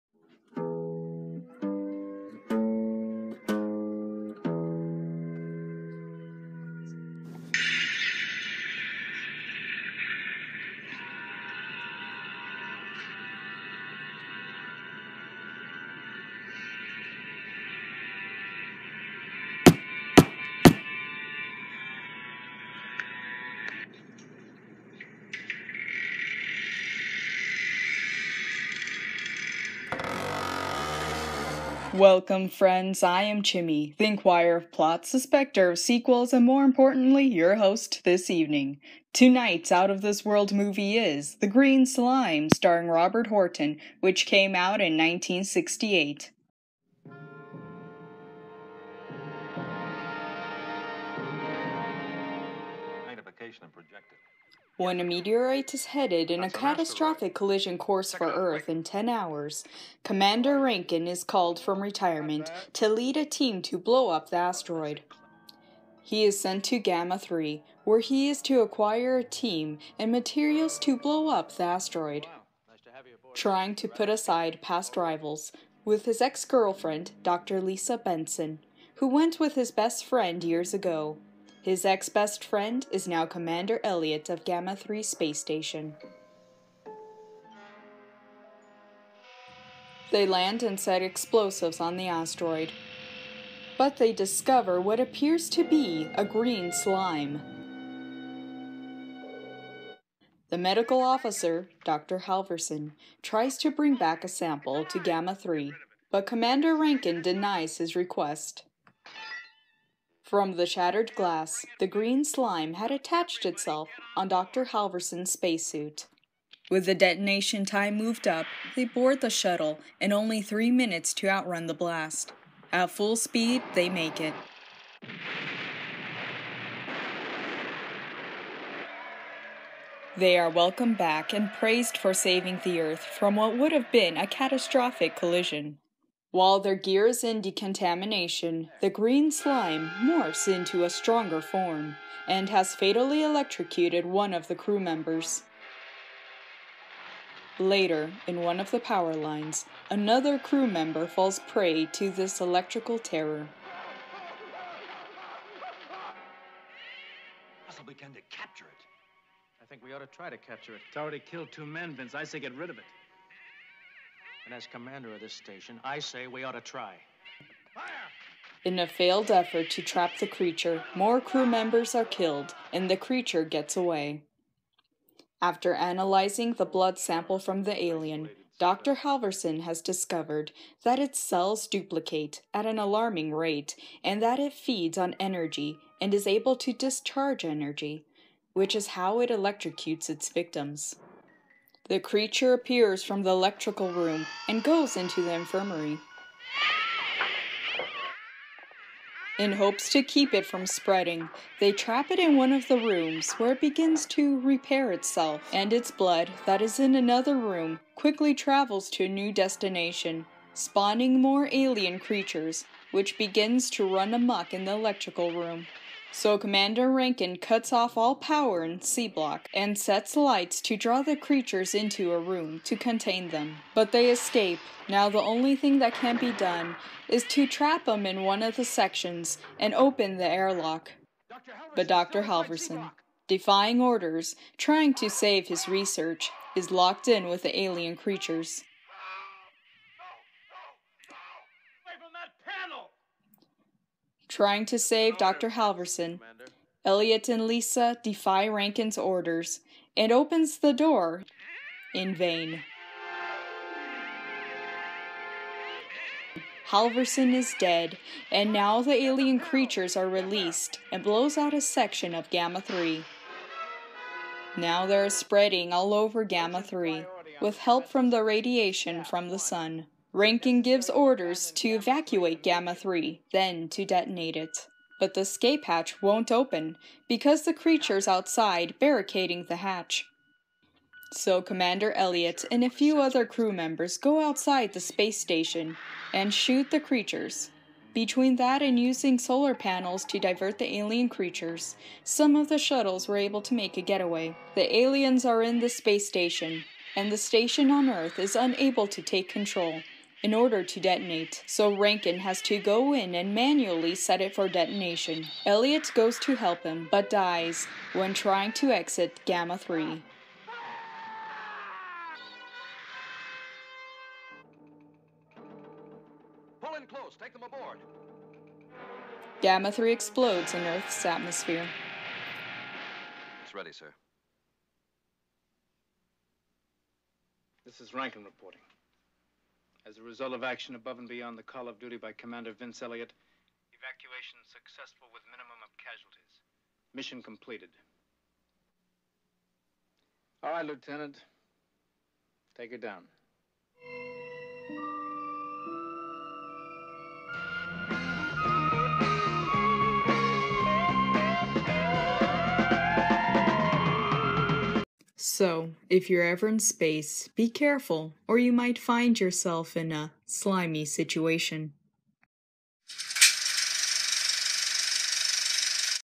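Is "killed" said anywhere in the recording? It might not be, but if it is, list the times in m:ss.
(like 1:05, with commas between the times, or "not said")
2:41, 2:52.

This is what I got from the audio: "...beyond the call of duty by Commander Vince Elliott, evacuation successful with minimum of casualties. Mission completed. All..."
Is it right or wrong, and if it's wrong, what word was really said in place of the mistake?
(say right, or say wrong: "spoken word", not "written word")
right.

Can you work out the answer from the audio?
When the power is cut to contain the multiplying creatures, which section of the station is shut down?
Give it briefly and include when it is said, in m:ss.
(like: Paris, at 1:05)
C Block, at 3:38.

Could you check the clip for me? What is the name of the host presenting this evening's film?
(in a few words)
Chimi.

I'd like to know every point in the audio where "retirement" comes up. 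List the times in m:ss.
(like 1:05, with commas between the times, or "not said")
1:01.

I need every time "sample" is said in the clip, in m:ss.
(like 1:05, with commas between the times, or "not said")
1:44, 2:56.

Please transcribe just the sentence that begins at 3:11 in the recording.
The creature appears from the electrical room and goes into the infirmary.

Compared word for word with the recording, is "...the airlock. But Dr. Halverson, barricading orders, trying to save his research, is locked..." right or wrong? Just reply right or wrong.
wrong.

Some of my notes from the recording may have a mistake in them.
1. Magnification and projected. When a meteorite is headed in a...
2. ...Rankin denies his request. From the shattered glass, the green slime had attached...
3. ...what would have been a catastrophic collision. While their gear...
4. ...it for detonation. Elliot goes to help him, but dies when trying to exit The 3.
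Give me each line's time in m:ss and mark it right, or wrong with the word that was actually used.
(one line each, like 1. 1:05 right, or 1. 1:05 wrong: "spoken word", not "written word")
1. 0:53 right
2. 1:46 right
3. 2:13 right
4. 5:04 wrong: "Gamma", not "The".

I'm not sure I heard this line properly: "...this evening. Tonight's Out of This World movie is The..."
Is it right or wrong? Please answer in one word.
right.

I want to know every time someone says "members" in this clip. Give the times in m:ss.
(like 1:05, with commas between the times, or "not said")
2:24, 2:30, 2:51, 4:43.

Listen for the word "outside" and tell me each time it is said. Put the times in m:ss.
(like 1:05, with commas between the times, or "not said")
4:38, 4:44.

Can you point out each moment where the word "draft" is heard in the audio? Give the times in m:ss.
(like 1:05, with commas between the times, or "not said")
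not said.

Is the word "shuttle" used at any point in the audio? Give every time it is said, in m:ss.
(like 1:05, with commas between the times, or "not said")
1:59, 4:52.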